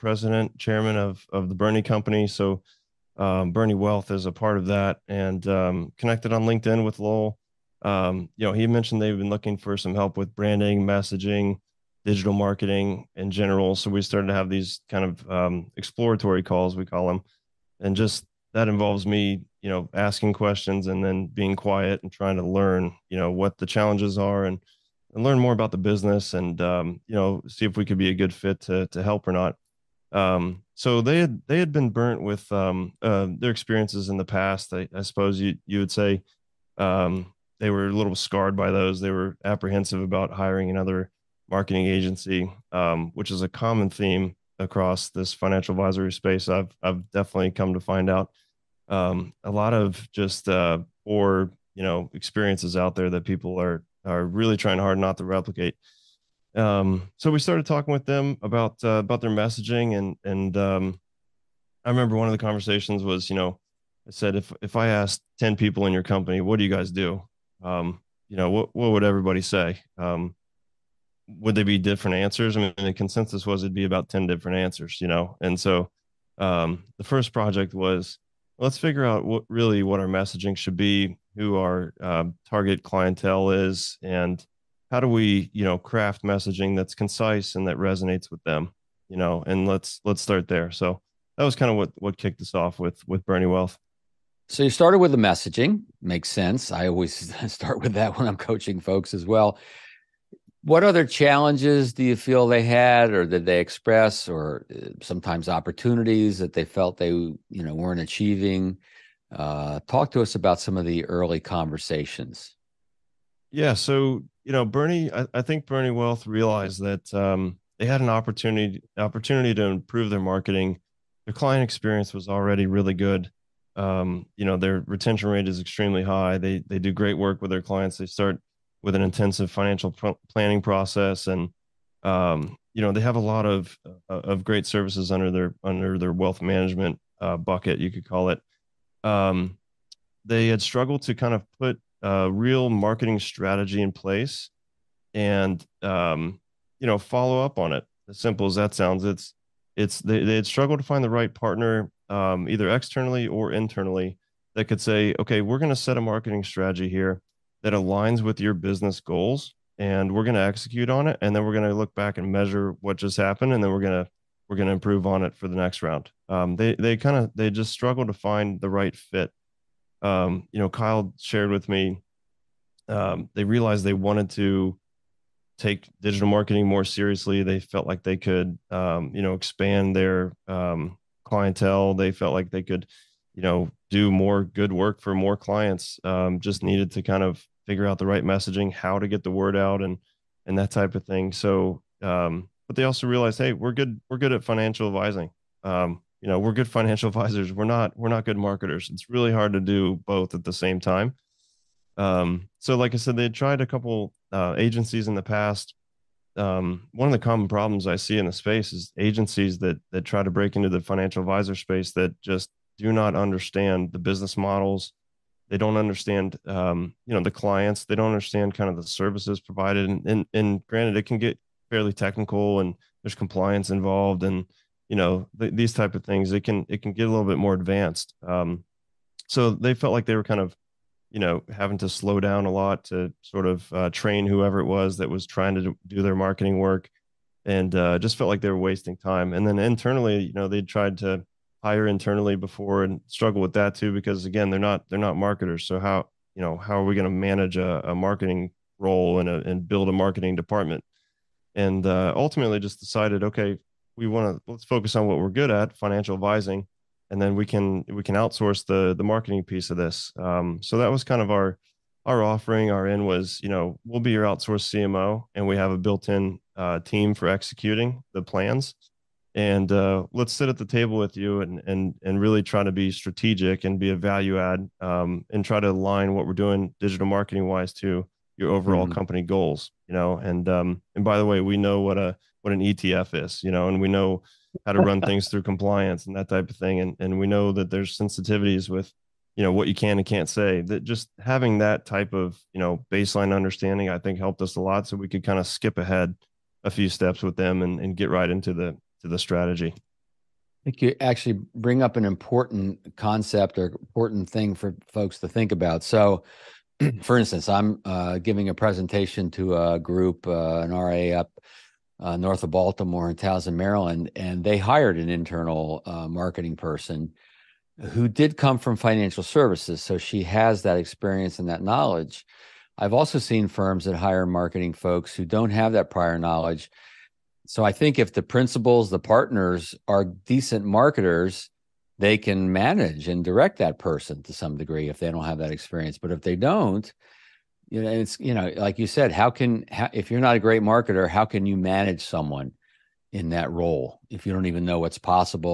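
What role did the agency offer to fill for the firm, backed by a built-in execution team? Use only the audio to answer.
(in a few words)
outsourced CMO.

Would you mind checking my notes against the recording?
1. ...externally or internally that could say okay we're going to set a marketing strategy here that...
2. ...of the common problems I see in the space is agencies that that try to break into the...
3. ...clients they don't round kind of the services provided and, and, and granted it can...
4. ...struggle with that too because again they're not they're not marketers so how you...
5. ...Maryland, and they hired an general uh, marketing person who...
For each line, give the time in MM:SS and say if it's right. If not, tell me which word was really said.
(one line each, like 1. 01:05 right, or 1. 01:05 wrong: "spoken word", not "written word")
1. 02:32 right
2. 03:27 right
3. 03:37 wrong: "understand", not "round"
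4. 04:03 right
5. 05:13 wrong: "internal", not "general".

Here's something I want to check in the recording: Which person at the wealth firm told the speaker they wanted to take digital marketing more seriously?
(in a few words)
Kyle.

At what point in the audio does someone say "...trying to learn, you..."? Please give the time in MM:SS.
00:22.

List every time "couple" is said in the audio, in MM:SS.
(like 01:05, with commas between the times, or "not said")
03:23.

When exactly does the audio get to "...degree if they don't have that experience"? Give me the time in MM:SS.
05:34.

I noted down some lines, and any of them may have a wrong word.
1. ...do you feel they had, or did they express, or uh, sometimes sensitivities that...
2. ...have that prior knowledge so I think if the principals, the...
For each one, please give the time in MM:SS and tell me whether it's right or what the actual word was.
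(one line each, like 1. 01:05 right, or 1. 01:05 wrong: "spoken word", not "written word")
1. 01:41 wrong: "opportunities", not "sensitivities"
2. 05:25 right.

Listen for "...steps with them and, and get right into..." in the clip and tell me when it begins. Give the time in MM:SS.
04:56.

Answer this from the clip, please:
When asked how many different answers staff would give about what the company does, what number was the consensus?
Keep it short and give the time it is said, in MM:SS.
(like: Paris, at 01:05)
10, at 01:14.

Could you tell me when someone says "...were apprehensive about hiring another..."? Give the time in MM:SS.
00:39.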